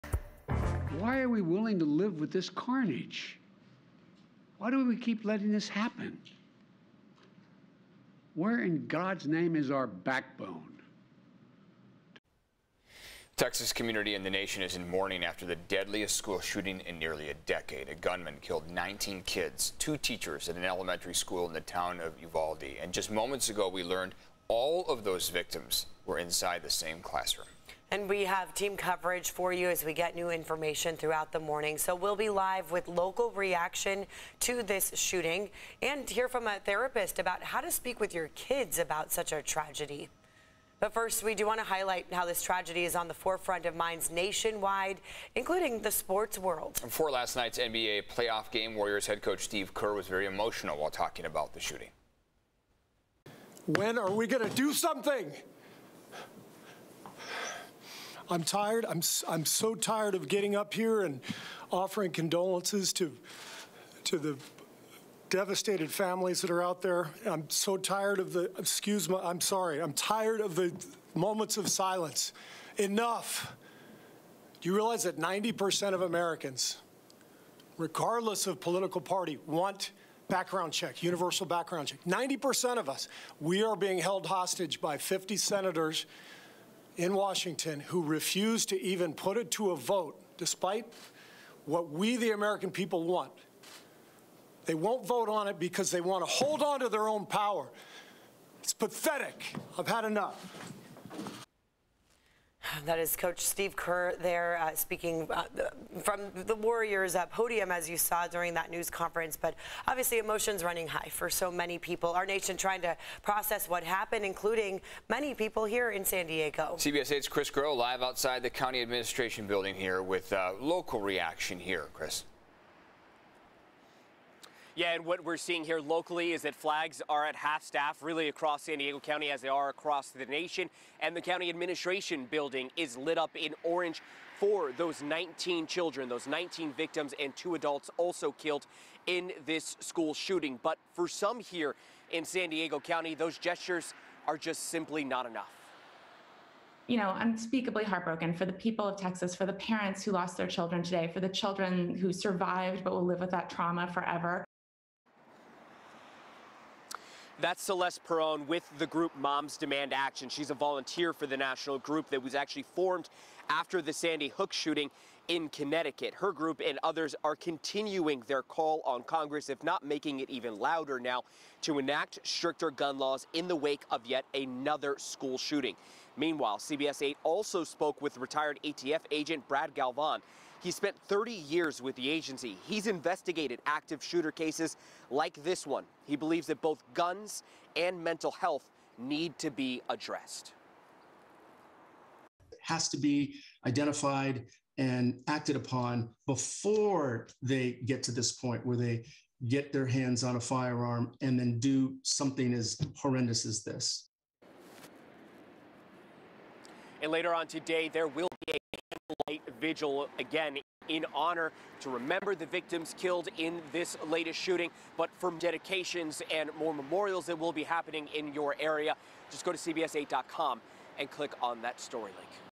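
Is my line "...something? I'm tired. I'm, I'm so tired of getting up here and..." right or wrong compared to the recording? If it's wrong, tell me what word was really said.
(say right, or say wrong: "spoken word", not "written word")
right.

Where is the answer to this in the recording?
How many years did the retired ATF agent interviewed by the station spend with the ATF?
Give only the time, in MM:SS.
03:01.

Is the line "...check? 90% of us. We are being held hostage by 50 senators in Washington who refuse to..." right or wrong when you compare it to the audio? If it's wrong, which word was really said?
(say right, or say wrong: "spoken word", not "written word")
right.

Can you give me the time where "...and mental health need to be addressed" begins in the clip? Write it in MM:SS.
03:07.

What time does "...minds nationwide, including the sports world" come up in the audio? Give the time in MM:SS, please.
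00:43.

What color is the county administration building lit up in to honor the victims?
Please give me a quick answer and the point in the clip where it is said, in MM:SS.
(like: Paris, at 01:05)
Orange, at 02:13.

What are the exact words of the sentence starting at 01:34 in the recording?
They won't vote on it because they want to hold on to their own power.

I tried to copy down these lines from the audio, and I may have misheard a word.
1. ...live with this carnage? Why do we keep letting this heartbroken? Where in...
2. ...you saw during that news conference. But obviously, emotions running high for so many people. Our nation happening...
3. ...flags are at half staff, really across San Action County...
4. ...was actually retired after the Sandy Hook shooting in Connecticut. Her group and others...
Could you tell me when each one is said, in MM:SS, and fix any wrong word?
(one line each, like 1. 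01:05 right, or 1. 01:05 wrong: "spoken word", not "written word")
1. 00:01 wrong: "happen", not "heartbroken"
2. 01:47 wrong: "trying", not "happening"
3. 02:06 wrong: "Diego", not "Action"
4. 02:42 wrong: "formed", not "retired".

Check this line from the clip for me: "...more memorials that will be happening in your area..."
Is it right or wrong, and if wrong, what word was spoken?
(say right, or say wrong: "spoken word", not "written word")
right.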